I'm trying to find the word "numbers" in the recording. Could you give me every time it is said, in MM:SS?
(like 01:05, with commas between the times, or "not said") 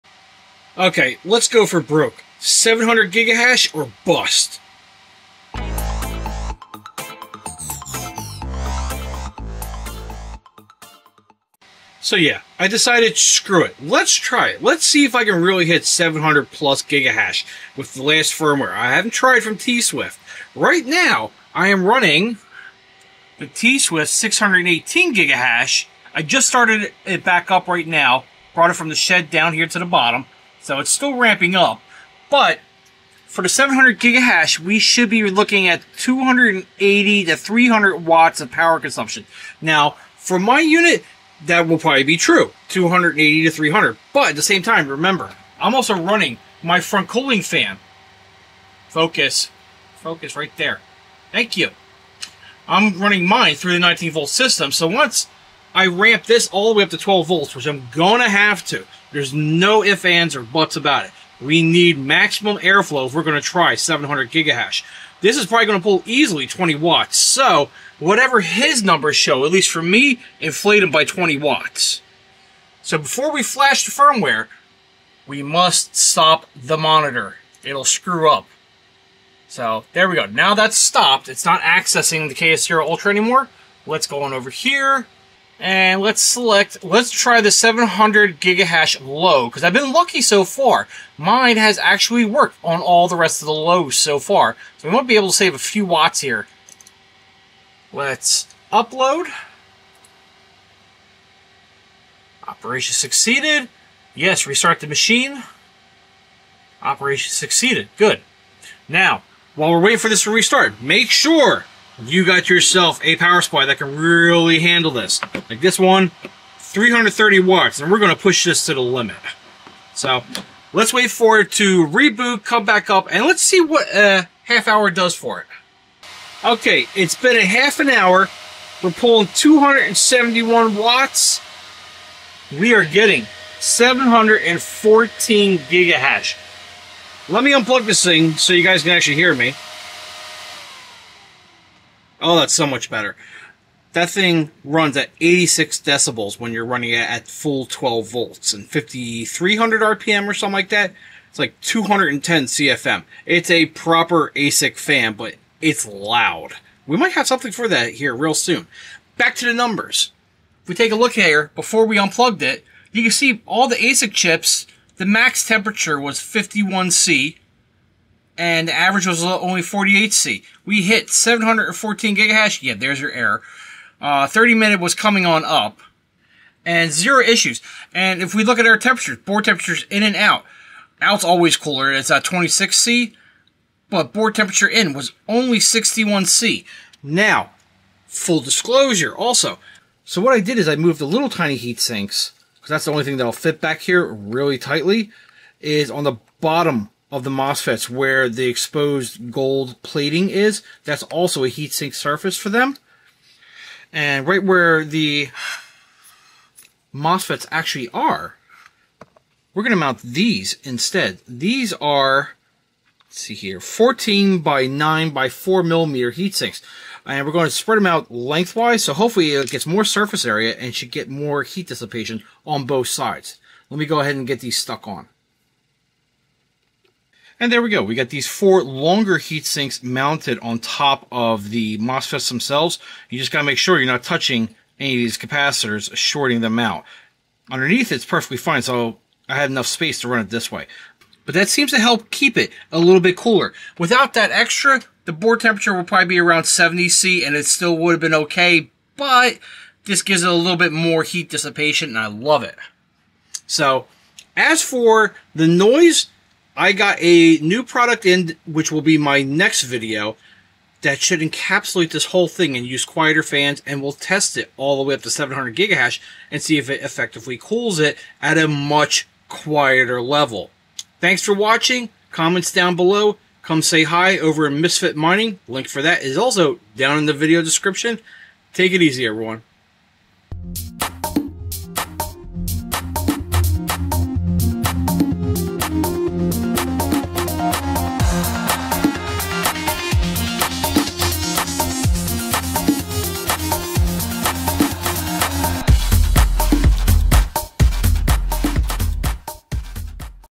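01:08, 02:39.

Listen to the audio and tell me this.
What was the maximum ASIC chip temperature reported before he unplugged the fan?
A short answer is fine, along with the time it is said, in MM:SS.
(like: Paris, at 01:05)
51C, at 02:46.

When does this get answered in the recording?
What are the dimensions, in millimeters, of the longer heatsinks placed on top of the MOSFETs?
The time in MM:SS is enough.
03:33.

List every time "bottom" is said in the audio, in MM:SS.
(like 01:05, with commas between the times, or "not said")
00:29, 03:16.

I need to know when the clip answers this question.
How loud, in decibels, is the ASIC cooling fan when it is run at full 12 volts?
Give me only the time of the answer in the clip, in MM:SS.
02:25.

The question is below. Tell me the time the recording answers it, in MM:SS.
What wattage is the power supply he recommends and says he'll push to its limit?
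01:56.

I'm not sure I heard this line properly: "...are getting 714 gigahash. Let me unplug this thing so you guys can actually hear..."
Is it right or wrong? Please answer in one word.
right.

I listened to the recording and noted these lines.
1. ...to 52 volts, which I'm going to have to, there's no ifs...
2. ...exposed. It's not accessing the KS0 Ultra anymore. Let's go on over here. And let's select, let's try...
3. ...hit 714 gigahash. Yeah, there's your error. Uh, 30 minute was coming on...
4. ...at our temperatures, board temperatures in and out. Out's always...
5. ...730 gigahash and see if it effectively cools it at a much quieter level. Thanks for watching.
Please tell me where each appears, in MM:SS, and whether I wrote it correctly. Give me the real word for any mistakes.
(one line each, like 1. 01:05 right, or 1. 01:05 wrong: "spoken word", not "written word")
1. 00:56 wrong: "12", not "52"
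2. 01:20 wrong: "stopped", not "exposed"
3. 02:50 right
4. 02:58 right
5. 04:25 wrong: "700", not "730".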